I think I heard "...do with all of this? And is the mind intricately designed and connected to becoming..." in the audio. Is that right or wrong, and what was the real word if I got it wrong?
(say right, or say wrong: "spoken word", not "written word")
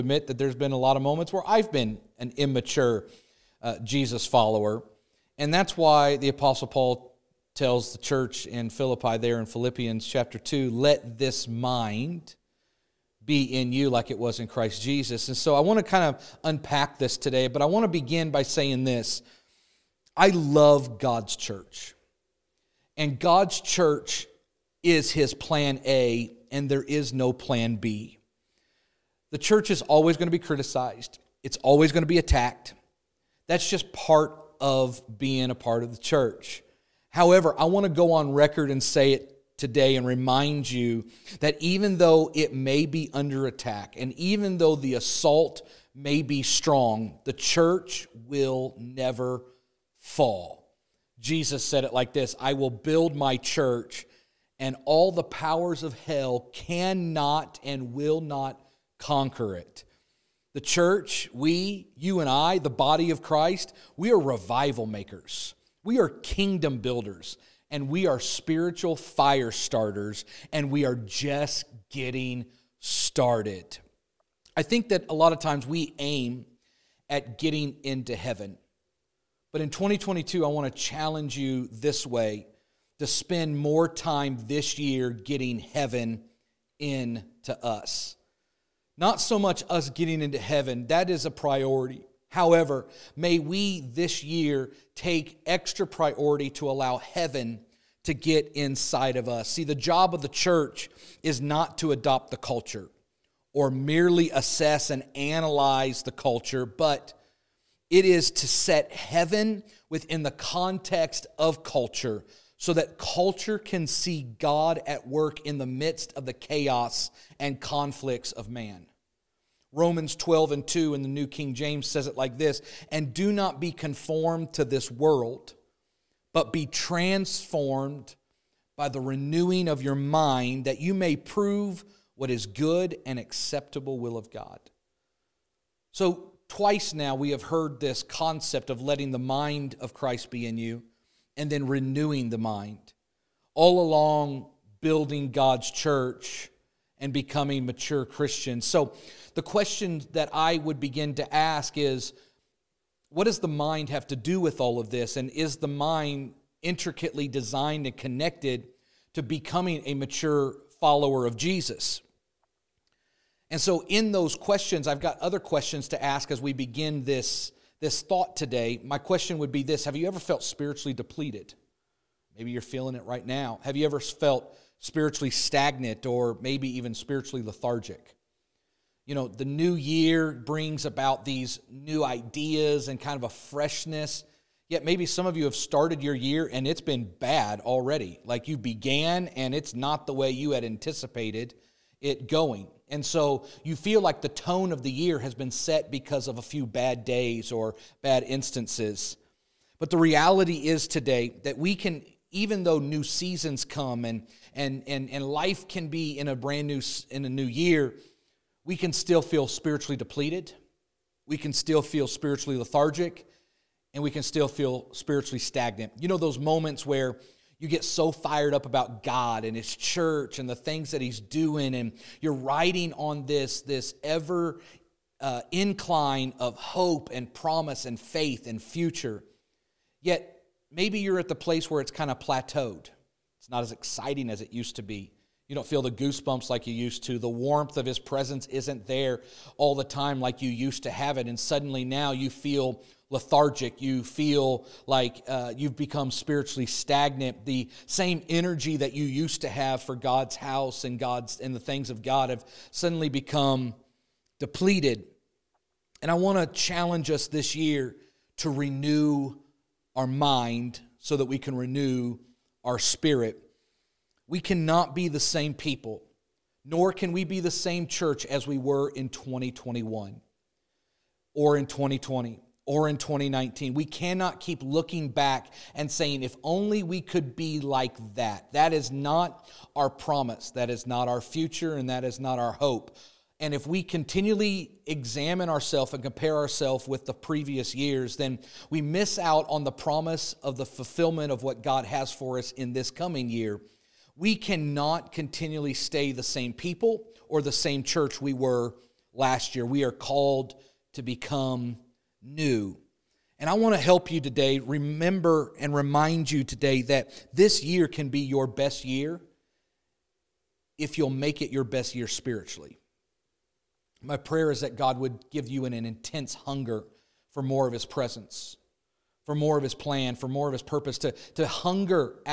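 right.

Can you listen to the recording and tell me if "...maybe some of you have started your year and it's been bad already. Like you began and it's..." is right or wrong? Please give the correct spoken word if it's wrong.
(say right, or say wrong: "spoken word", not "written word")
right.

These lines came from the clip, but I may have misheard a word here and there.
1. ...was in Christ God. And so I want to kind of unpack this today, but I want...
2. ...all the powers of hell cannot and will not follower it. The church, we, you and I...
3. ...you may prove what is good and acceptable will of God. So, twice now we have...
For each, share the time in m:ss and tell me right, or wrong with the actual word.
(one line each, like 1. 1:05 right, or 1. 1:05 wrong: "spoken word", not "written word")
1. 0:14 wrong: "Jesus", not "God"
2. 0:54 wrong: "conquer", not "follower"
3. 2:10 right.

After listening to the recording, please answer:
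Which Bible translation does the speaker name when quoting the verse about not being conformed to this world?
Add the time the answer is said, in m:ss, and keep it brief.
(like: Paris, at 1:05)
New King James, at 2:01.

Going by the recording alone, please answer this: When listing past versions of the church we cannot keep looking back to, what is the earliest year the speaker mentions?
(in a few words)
2019.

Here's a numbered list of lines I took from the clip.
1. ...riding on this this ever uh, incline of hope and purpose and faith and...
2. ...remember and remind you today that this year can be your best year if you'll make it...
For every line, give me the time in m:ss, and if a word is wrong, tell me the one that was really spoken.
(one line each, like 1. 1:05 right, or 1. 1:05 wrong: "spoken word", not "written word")
1. 3:42 wrong: "promise", not "purpose"
2. 5:04 right.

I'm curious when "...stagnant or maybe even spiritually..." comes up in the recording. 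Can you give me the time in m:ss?
2:55.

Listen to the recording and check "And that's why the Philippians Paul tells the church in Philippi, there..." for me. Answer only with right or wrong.
wrong.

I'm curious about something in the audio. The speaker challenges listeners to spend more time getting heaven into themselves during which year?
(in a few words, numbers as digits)
2022.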